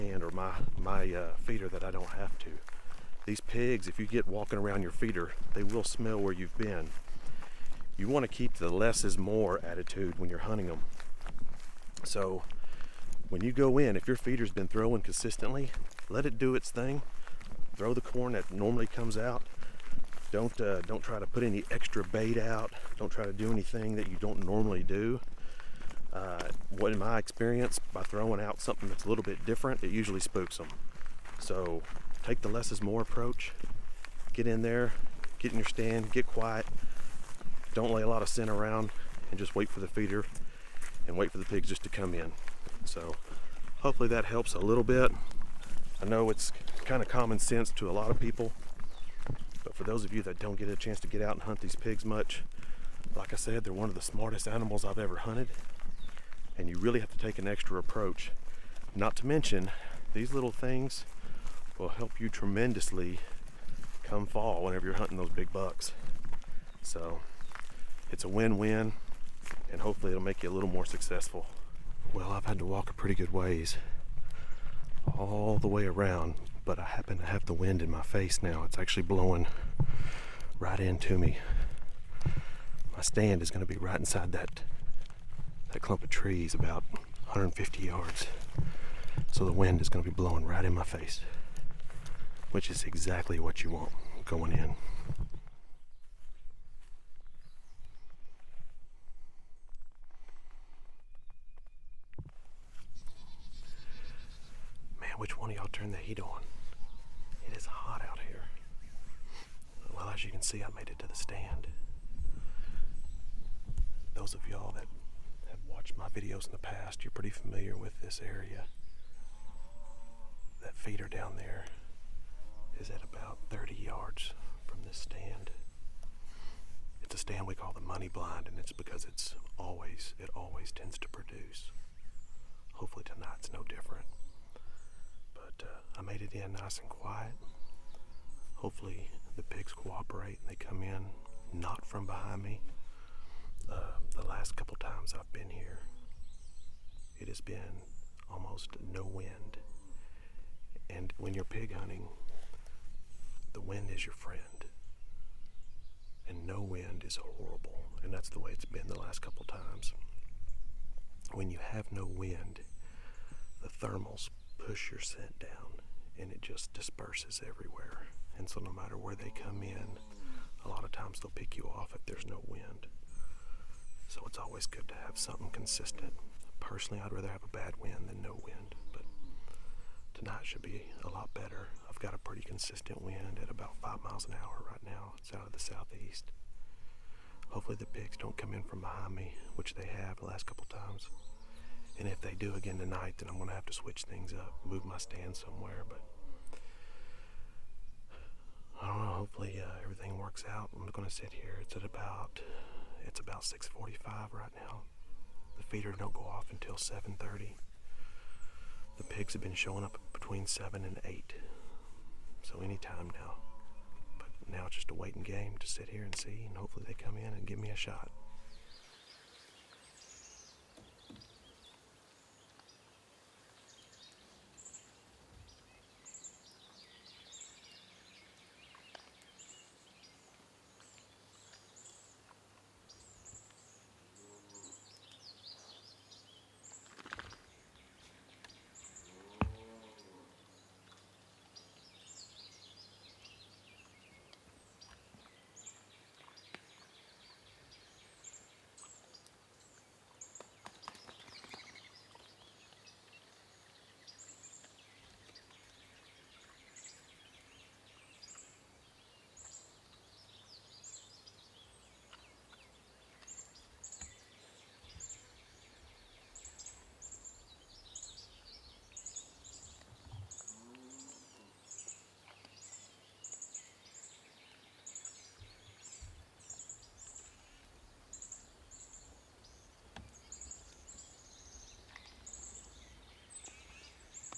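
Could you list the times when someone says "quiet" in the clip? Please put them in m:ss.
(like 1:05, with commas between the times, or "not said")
0:36, 2:16.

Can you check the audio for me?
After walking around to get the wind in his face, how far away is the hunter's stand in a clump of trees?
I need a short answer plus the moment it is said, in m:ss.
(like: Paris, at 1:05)
150 yards, at 1:26.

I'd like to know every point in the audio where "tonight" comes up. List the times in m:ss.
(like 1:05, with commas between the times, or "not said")
2:13, 3:00, 3:12.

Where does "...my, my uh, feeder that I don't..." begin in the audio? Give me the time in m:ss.
0:00.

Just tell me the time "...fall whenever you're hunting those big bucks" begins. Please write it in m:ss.
1:04.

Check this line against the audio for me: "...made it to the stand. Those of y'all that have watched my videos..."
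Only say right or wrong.
right.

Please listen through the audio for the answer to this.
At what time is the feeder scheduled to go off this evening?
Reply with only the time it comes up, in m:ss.
3:26.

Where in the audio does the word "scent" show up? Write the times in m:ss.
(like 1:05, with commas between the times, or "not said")
0:38, 2:44.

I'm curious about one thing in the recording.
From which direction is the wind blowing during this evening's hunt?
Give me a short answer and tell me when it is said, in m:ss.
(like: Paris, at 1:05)
southeast, at 3:05.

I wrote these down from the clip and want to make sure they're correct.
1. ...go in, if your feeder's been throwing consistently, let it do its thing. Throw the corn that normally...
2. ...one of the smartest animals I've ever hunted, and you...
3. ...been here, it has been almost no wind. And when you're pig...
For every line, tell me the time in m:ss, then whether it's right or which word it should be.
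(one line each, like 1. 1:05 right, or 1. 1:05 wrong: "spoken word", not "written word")
1. 0:13 right
2. 0:53 right
3. 2:25 right.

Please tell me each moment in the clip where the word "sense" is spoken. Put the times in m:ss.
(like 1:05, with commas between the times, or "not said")
0:47.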